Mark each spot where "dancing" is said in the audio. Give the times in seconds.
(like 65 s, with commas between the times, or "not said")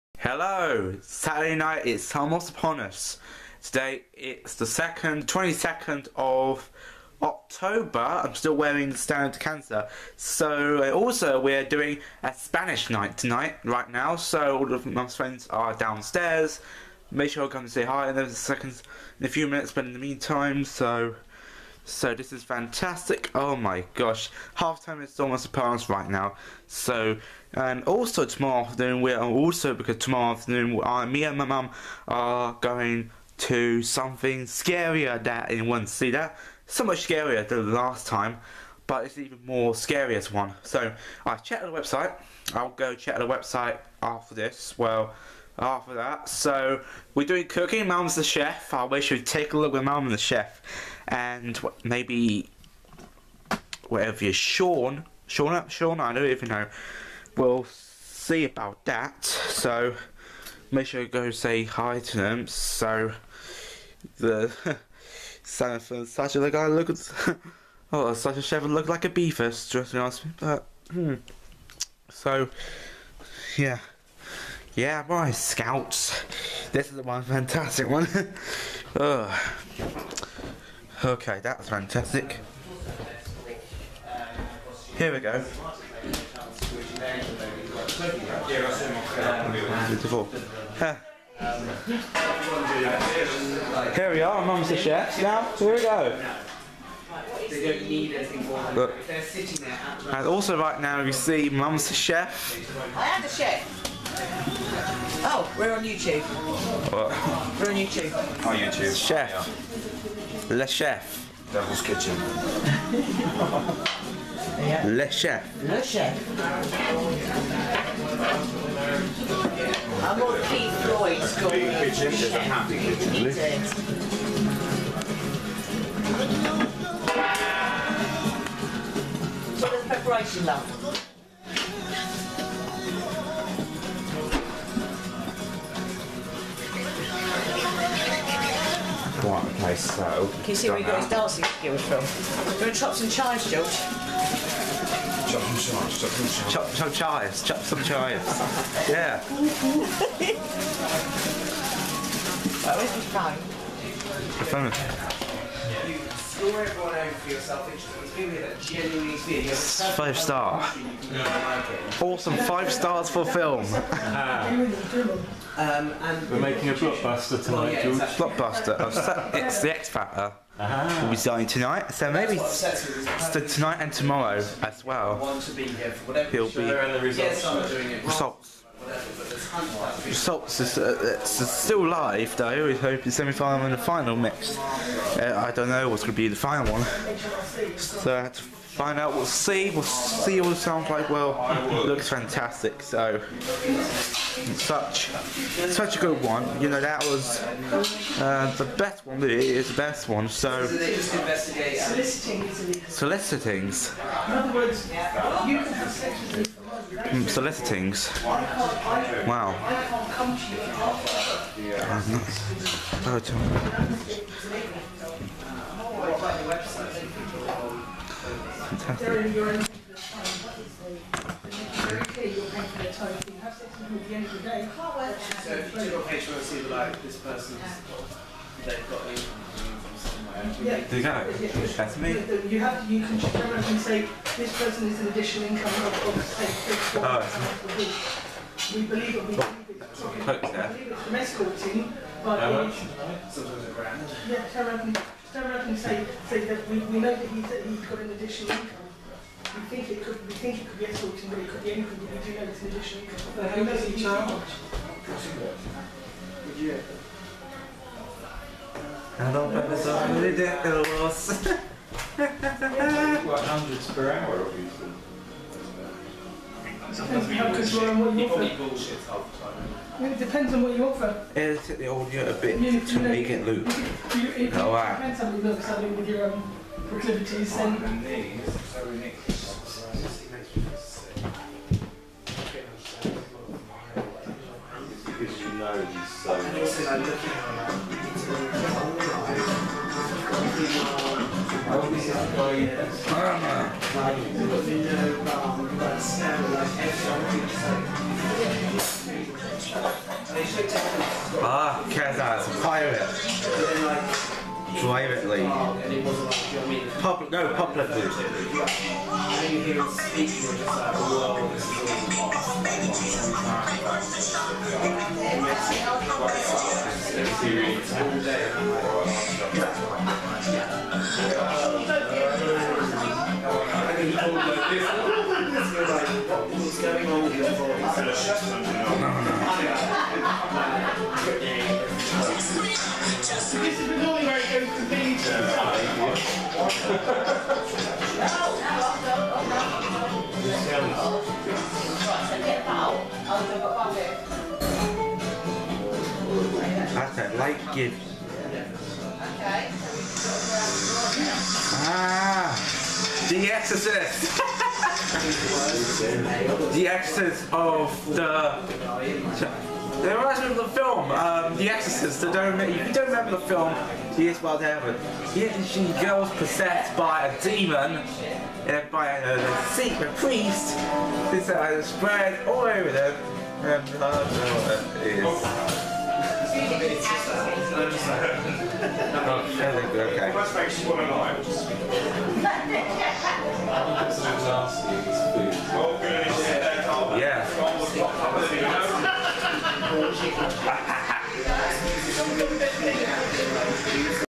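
141 s.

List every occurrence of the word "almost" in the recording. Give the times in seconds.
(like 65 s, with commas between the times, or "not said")
2 s, 25 s.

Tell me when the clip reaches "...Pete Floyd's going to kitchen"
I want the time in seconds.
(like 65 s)
120 s.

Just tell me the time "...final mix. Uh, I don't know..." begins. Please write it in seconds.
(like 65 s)
183 s.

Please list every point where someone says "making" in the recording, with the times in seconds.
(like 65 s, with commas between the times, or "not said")
166 s.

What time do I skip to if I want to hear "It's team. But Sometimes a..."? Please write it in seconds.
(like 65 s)
241 s.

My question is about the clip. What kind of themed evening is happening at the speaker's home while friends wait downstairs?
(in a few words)
Spanish night.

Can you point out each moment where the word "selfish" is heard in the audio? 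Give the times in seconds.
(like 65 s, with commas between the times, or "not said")
157 s.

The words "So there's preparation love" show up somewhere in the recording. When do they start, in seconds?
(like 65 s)
129 s.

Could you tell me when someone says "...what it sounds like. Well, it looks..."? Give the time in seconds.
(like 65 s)
190 s.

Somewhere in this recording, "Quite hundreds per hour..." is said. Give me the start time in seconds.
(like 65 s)
262 s.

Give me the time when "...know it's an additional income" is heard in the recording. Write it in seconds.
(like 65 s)
252 s.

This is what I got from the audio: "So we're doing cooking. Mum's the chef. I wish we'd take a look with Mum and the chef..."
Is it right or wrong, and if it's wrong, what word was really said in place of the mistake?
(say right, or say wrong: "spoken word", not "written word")
right.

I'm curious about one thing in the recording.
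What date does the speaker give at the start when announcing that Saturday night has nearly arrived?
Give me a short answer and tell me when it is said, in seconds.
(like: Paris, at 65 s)
22nd of October, at 5 s.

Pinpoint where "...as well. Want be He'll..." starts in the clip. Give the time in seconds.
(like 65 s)
174 s.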